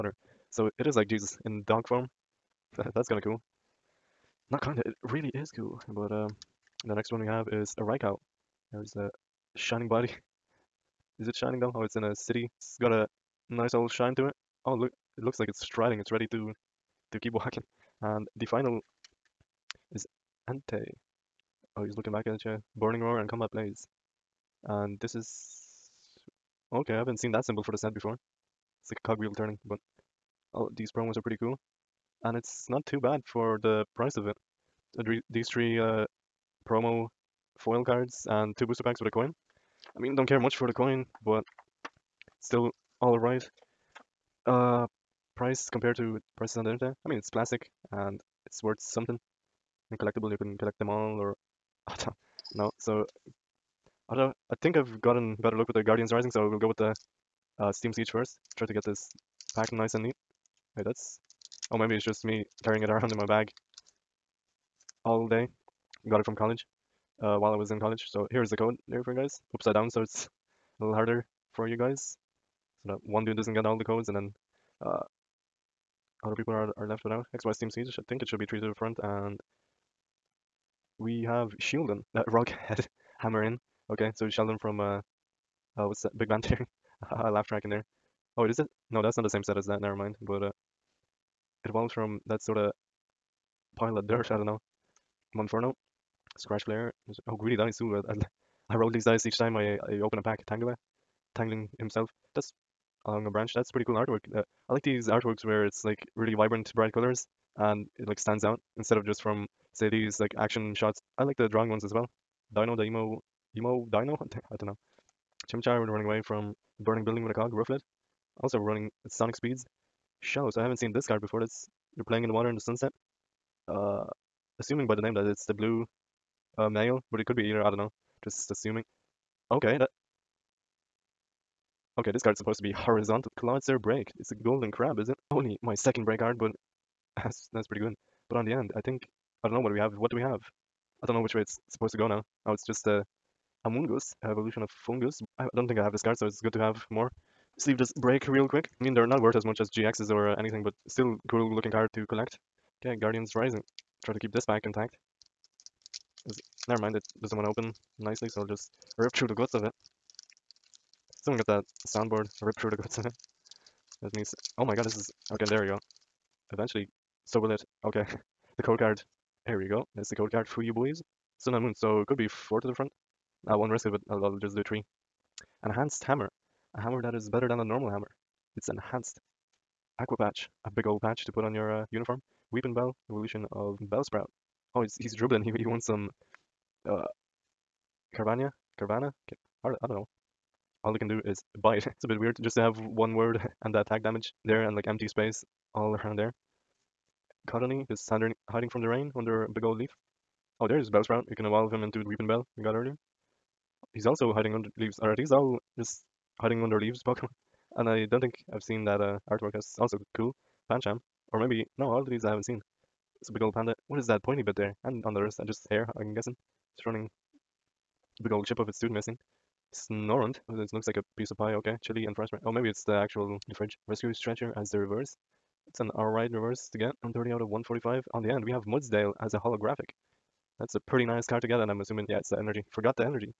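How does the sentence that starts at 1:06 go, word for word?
Got it from college uh, while I was in college.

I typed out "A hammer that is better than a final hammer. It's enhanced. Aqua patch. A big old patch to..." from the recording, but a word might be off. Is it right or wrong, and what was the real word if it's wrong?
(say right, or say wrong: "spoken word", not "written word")
wrong: "normal", not "final".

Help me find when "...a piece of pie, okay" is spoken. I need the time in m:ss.
3:40.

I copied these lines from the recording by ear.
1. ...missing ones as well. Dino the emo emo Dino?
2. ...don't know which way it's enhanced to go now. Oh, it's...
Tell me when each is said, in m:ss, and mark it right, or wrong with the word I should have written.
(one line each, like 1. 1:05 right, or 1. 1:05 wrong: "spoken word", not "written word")
1. 1:51 wrong: "drawing", not "missing"
2. 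2:21 wrong: "supposed", not "enhanced".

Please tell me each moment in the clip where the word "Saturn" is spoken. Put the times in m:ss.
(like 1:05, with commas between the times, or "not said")
3:18.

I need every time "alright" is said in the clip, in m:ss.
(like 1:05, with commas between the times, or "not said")
0:43, 3:45.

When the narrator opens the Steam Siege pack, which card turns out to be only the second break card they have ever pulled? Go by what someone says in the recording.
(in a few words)
Clawitzer BREAK.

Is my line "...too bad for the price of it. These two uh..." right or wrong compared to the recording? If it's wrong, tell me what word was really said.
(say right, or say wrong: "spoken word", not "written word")
wrong: "three", not "two".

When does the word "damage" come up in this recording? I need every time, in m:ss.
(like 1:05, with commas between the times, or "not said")
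3:14.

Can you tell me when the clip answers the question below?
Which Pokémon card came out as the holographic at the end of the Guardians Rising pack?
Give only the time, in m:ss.
3:48.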